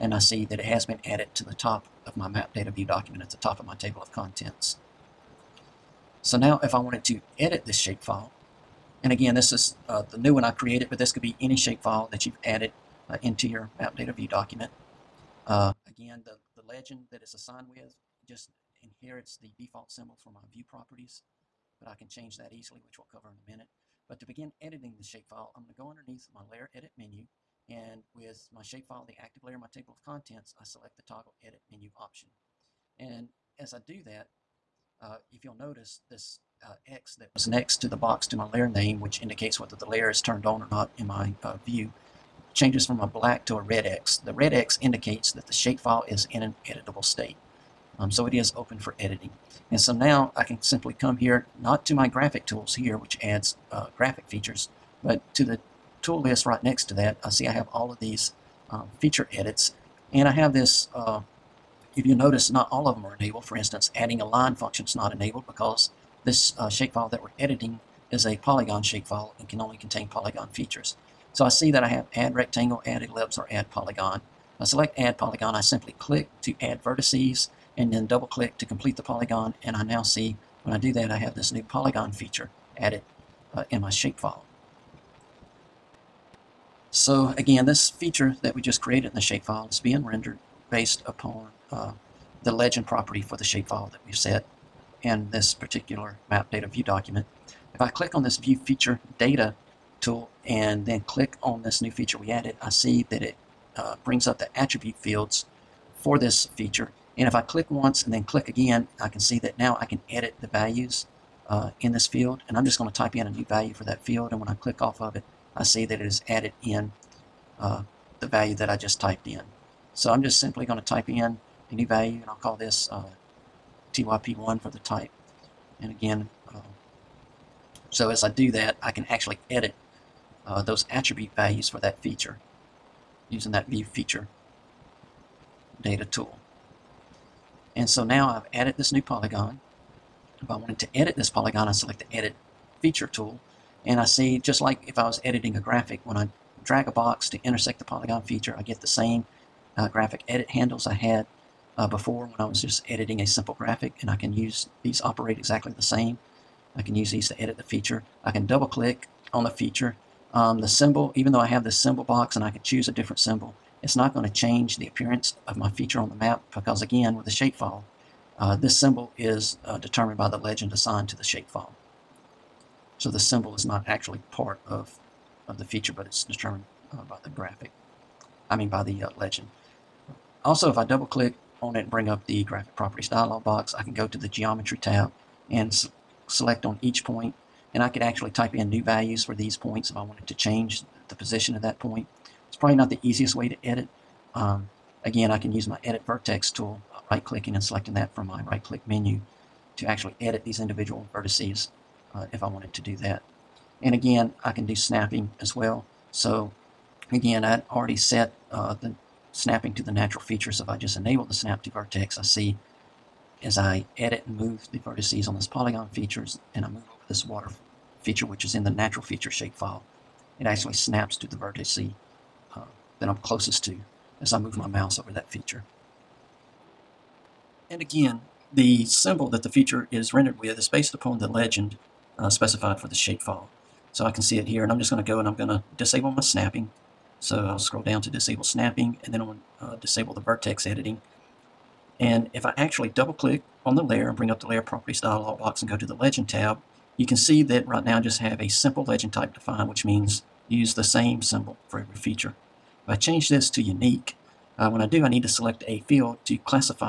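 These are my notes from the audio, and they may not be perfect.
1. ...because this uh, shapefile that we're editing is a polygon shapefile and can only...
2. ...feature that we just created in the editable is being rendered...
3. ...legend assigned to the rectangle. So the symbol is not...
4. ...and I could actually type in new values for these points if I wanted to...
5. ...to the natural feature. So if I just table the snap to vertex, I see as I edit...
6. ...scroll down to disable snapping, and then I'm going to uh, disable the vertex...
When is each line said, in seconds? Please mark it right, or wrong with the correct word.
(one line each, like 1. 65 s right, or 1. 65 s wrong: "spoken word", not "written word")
1. 65 s right
2. 87 s wrong: "shapefile", not "editable"
3. 170 s wrong: "shapefile", not "rectangle"
4. 187 s right
5. 209 s wrong: "enable", not "table"
6. 237 s right.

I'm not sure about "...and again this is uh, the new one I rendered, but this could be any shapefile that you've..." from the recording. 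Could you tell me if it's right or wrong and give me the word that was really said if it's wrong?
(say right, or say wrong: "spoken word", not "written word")
wrong: "created", not "rendered".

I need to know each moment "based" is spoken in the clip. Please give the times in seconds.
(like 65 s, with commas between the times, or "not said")
90 s, 230 s.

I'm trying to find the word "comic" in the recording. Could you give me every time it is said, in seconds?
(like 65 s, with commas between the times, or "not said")
not said.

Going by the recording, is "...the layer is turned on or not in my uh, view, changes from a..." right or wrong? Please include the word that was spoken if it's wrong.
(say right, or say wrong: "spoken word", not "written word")
right.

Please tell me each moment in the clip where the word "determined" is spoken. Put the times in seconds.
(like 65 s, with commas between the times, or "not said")
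169 s, 176 s.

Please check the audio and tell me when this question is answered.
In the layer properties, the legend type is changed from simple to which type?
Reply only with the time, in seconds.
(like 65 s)
253 s.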